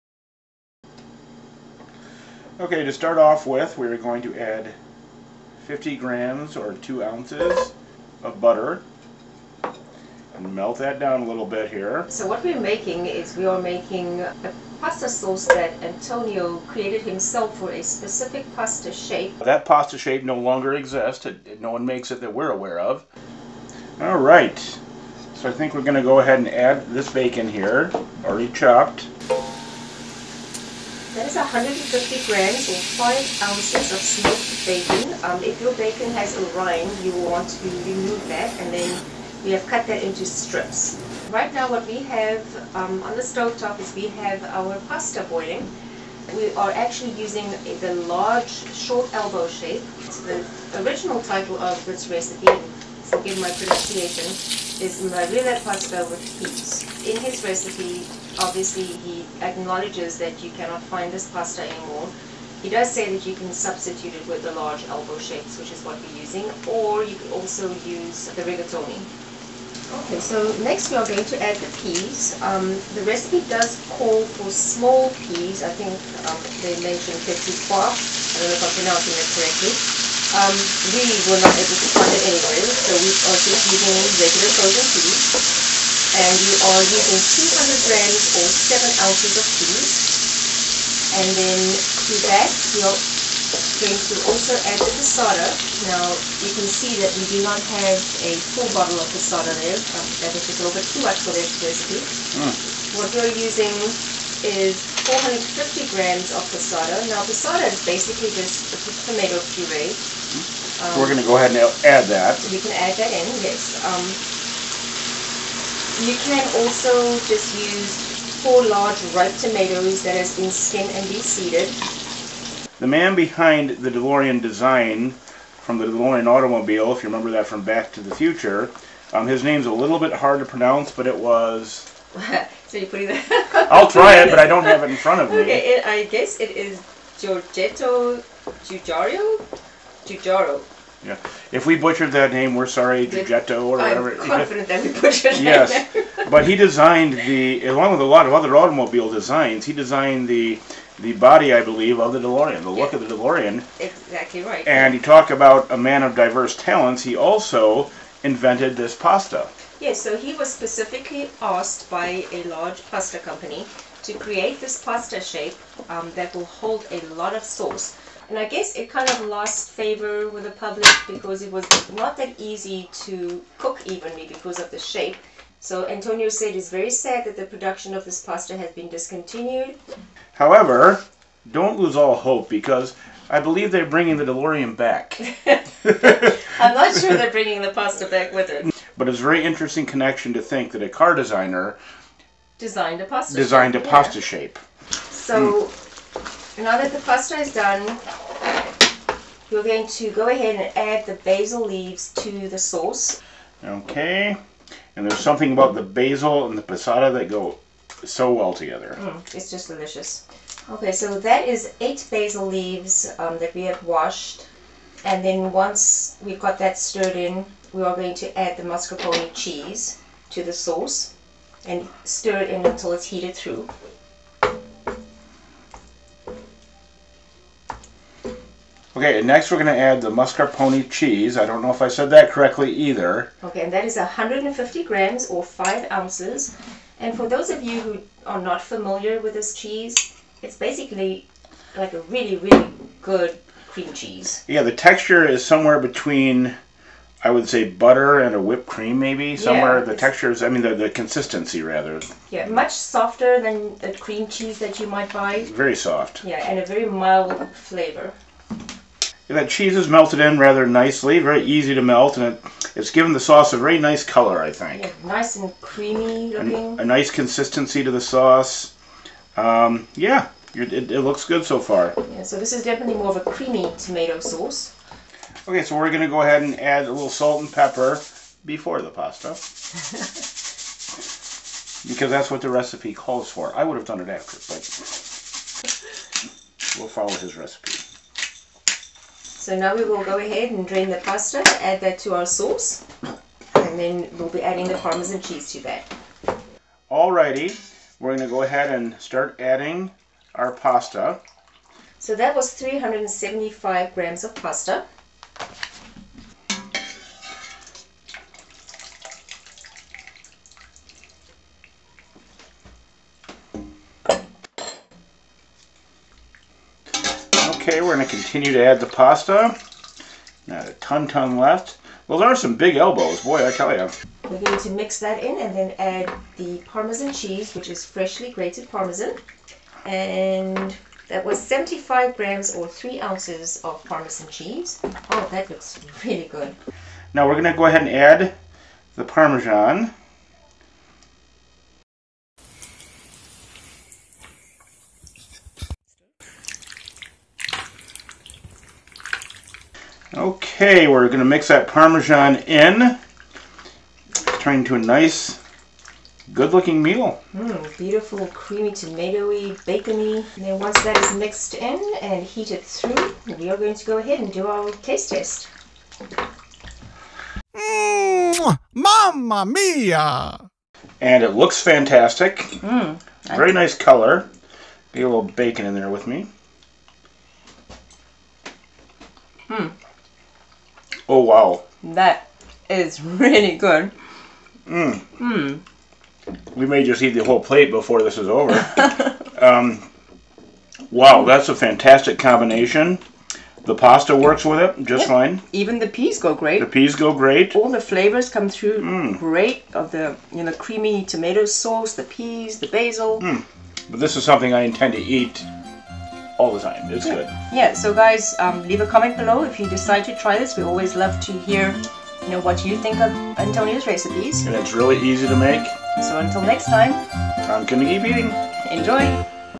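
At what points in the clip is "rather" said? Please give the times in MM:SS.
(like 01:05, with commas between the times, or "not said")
04:11, 04:20.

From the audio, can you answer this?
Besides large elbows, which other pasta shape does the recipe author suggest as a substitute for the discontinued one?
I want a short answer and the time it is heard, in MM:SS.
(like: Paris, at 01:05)
rigatoni, at 01:08.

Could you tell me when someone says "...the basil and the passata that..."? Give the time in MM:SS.
03:25.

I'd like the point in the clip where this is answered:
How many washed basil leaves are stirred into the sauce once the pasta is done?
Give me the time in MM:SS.
03:31.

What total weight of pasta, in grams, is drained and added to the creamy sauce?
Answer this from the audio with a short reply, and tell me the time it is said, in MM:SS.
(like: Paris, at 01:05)
375 grams, at 05:02.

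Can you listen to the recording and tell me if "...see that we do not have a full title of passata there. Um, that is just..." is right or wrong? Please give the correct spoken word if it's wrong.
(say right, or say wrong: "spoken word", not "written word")
wrong: "bottle", not "title".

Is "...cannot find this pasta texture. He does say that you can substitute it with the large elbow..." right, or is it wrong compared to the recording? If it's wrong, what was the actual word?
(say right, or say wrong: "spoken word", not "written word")
wrong: "anymore", not "texture".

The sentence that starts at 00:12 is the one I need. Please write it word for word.
So what we're making is we are making a pasta sauce that Antonio created himself for a specific pasta shape.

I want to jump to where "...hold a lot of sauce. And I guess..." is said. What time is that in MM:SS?
02:46.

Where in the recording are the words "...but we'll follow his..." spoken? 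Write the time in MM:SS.
04:44.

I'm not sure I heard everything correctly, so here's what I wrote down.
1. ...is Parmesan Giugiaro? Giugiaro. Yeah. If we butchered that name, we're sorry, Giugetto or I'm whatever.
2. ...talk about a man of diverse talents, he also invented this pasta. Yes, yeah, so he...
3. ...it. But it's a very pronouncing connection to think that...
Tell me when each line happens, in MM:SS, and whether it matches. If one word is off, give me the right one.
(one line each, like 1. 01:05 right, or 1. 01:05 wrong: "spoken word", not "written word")
1. 02:16 wrong: "Giorgetto", not "Parmesan"
2. 02:34 right
3. 03:08 wrong: "interesting", not "pronouncing".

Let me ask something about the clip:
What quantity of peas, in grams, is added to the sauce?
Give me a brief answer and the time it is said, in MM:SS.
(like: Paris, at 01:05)
200 grams, at 01:27.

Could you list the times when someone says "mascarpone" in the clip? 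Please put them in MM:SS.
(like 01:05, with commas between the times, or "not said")
03:38, 03:50.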